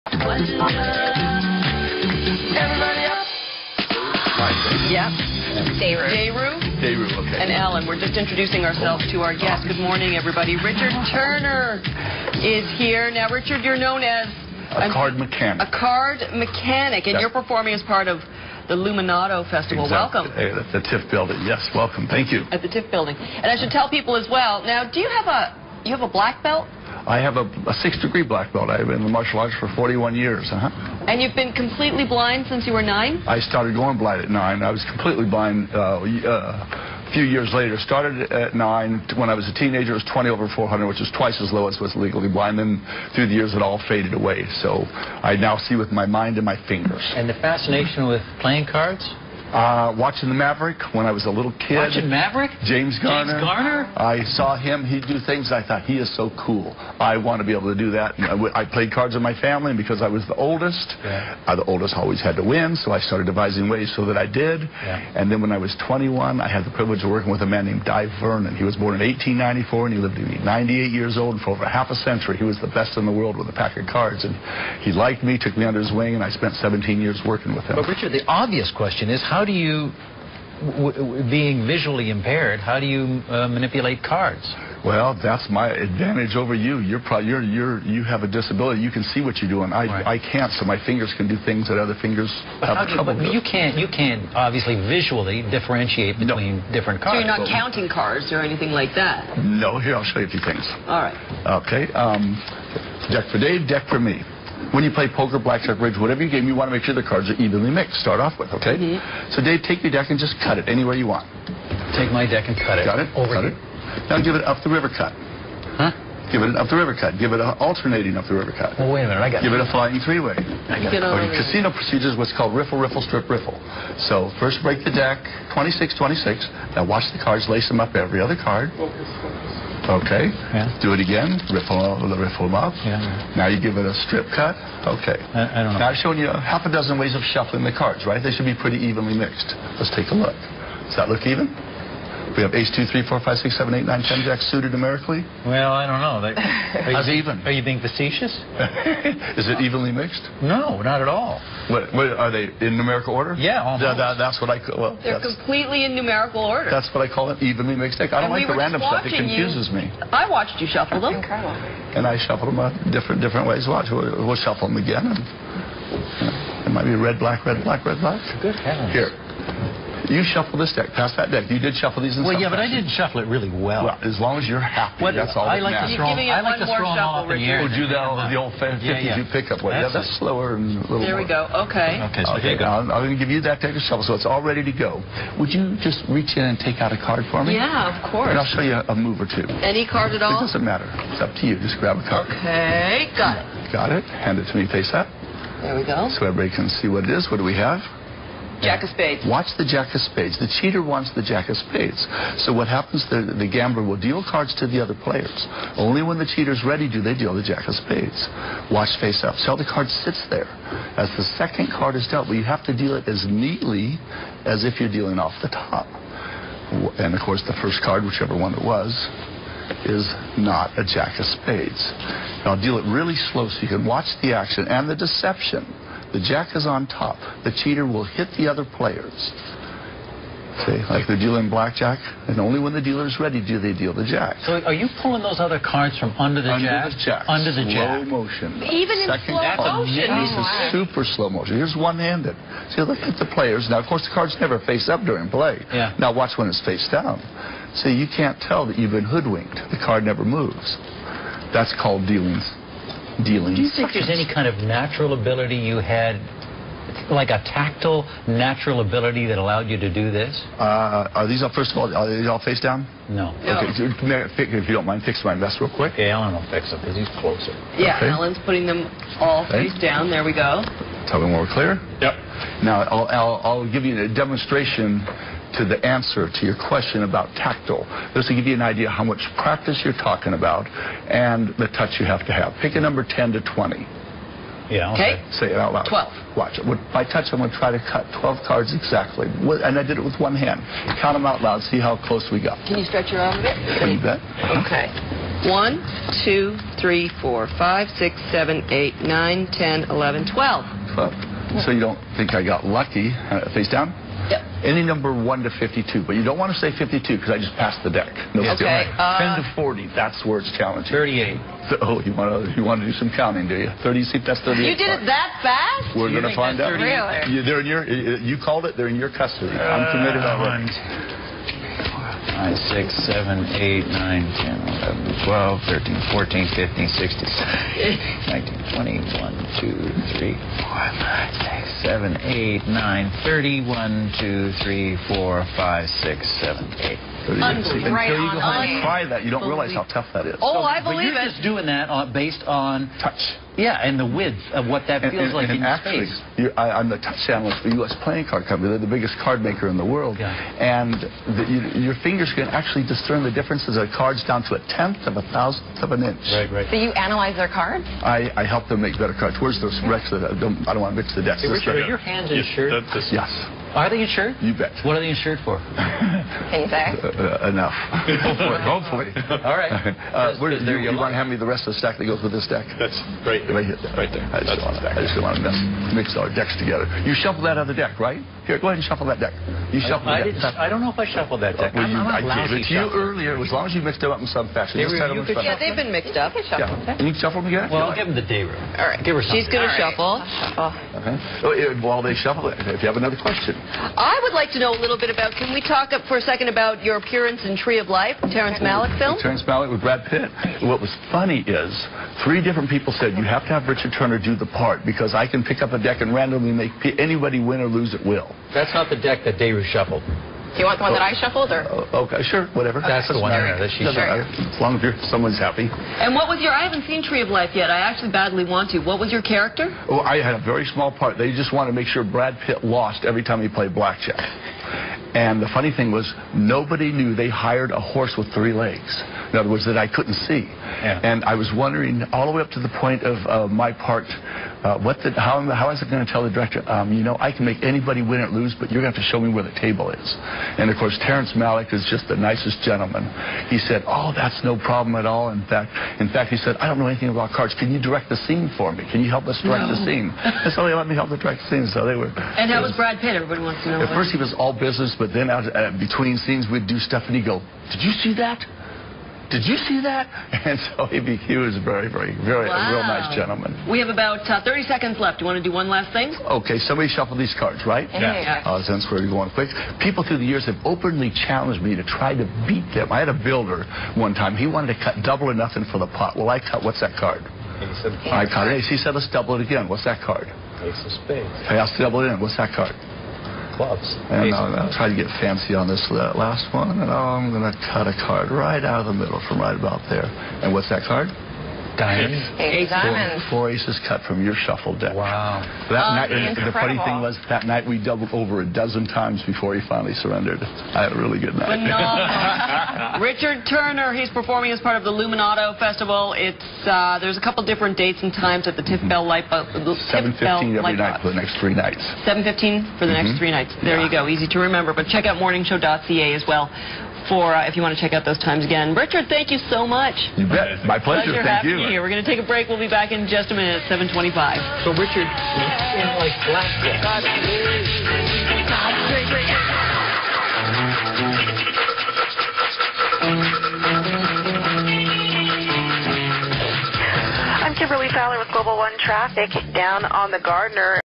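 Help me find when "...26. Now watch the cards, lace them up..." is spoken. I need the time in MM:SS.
02:06.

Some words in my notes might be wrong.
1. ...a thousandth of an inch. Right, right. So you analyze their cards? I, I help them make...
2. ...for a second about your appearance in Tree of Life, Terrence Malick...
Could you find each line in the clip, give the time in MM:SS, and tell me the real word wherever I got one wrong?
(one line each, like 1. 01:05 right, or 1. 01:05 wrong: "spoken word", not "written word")
1. 05:55 right
2. 06:36 right.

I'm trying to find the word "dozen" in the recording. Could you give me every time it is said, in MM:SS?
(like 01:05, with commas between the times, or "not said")
02:16, 08:18.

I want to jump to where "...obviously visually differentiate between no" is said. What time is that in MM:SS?
01:34.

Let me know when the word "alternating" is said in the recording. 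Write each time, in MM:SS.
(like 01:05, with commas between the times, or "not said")
01:57.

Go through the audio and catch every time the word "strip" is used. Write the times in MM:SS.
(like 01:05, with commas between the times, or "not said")
02:03, 02:14.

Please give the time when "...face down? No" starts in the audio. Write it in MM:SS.
04:22.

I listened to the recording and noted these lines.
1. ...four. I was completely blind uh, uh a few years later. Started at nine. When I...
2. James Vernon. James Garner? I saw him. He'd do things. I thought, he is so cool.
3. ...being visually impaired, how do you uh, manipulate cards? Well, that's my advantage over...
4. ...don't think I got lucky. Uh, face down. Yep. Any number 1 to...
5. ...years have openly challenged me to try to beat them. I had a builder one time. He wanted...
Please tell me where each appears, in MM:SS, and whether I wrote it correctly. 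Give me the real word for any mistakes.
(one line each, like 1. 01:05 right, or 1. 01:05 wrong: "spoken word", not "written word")
1. 00:34 wrong: "nine", not "four"
2. 00:52 wrong: "Garner", not "Vernon"
3. 01:21 right
4. 05:01 right
5. 07:50 right.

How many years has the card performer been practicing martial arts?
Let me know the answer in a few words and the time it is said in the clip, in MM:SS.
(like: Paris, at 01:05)
41, at 00:29.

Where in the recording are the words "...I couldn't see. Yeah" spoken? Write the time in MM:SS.
07:09.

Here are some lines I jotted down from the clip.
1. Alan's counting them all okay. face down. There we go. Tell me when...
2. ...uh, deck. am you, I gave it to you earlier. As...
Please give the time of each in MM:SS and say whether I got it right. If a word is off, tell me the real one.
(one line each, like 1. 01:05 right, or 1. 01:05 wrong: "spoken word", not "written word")
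1. 04:28 wrong: "putting", not "counting"
2. 06:21 right.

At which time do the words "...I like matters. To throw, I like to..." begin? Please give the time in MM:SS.
02:55.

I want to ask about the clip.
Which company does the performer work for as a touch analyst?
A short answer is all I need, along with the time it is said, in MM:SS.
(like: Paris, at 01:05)
U.S. Playing Card Company, at 05:47.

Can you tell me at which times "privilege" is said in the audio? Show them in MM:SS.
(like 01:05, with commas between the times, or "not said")
01:06.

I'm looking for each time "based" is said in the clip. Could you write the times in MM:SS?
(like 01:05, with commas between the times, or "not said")
05:42.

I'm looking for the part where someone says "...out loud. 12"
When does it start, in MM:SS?
04:45.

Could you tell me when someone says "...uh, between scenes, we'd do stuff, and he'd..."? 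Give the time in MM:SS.
07:35.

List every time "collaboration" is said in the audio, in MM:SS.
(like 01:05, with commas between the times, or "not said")
not said.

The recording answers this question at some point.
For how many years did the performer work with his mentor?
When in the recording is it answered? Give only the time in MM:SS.
01:16.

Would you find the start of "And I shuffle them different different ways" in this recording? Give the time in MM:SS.
02:41.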